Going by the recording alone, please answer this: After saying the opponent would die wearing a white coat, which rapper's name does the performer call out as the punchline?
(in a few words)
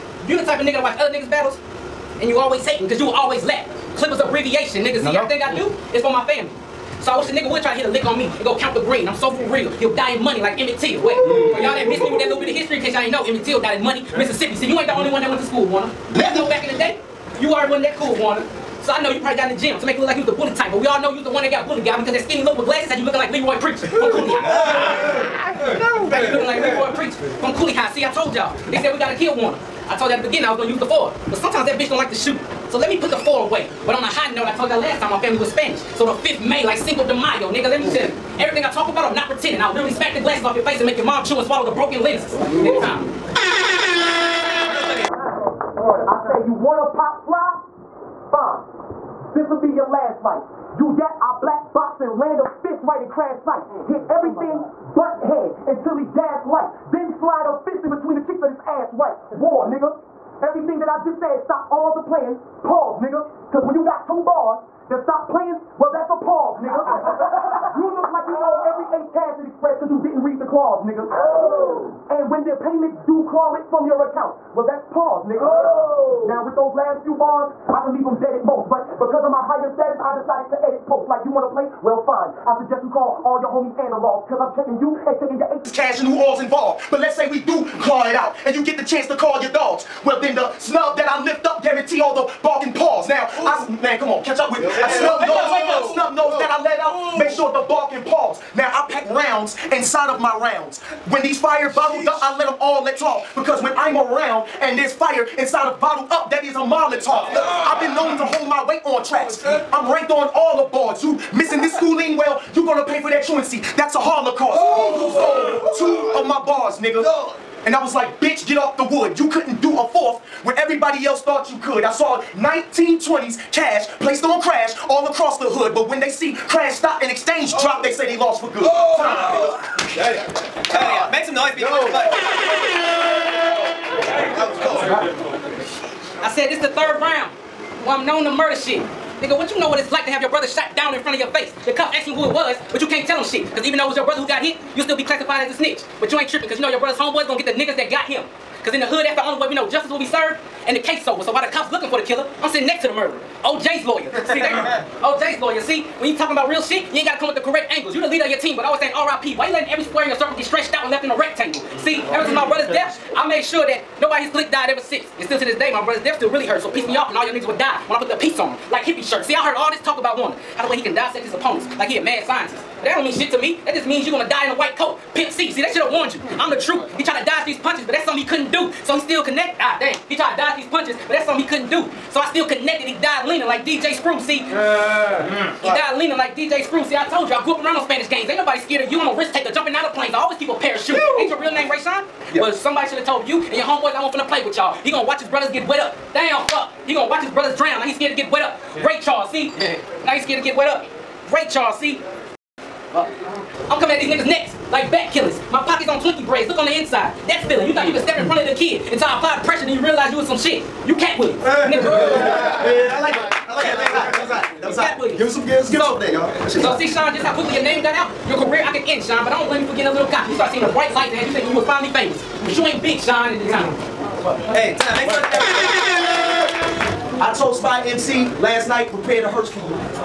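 Pimp C.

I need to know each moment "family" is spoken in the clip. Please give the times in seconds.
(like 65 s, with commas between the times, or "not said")
6 s, 35 s.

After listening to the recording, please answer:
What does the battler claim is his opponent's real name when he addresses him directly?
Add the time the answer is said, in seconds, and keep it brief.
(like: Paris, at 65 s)
Rayshawn, at 191 s.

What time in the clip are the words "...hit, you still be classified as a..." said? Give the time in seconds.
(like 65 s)
144 s.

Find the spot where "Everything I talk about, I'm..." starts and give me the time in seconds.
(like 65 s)
38 s.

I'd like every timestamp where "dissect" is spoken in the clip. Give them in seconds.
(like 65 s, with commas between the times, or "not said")
170 s.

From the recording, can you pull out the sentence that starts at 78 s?
But because of my higher status, I decided to edit like you want to play?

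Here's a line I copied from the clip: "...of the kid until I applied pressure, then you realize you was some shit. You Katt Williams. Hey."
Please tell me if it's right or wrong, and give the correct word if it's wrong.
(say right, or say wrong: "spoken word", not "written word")
right.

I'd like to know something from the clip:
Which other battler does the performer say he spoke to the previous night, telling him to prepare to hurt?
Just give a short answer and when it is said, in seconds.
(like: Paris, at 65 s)
Spy MC, at 227 s.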